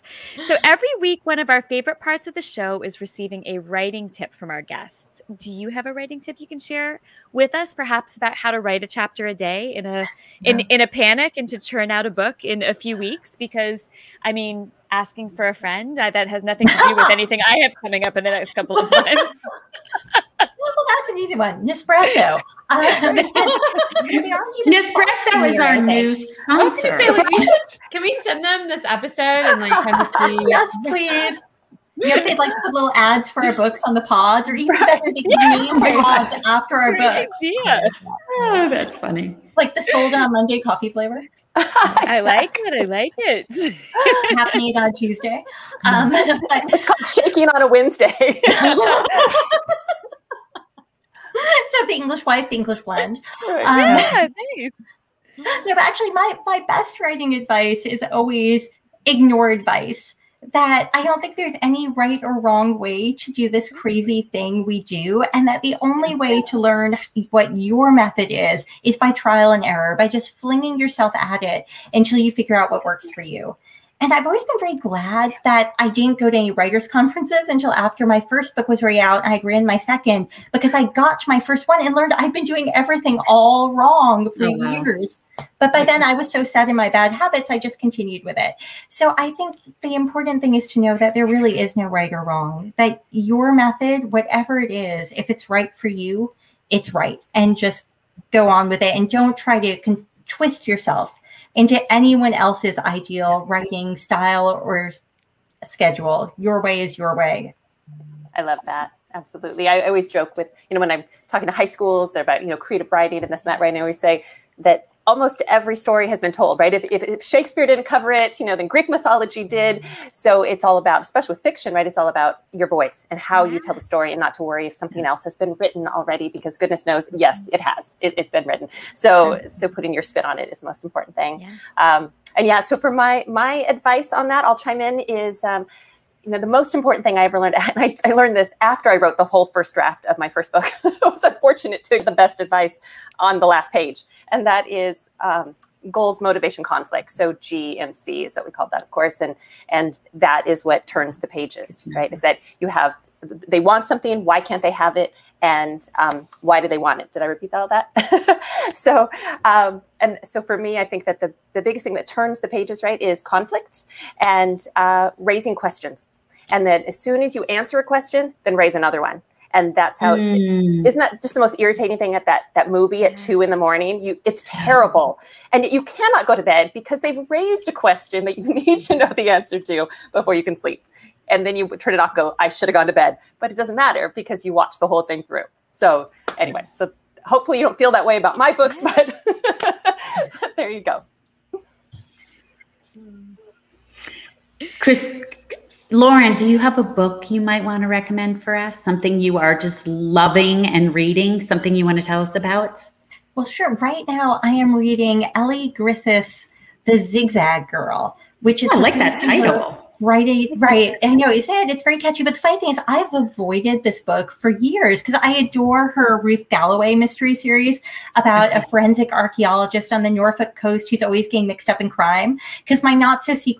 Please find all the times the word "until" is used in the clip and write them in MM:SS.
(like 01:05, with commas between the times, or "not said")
01:11, 01:17.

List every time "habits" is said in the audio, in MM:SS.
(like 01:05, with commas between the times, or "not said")
01:27.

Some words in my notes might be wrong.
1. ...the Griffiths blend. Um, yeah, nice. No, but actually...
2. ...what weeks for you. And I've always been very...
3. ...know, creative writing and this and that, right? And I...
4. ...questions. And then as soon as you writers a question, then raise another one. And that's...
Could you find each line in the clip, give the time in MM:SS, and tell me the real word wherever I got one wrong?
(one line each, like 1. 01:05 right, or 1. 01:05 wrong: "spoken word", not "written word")
1. 00:52 wrong: "English", not "Griffiths"
2. 01:12 wrong: "works", not "weeks"
3. 01:52 right
4. 02:45 wrong: "answer", not "writers".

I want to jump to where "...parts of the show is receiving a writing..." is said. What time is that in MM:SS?
00:01.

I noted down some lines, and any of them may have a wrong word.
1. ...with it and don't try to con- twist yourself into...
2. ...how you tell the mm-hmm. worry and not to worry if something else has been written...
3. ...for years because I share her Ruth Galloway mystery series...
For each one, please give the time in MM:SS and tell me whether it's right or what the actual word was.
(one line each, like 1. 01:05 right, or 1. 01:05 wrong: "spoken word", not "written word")
1. 01:38 right
2. 02:03 wrong: "story", not "worry"
3. 03:34 wrong: "adore", not "share".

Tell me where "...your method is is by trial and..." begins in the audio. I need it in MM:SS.
01:07.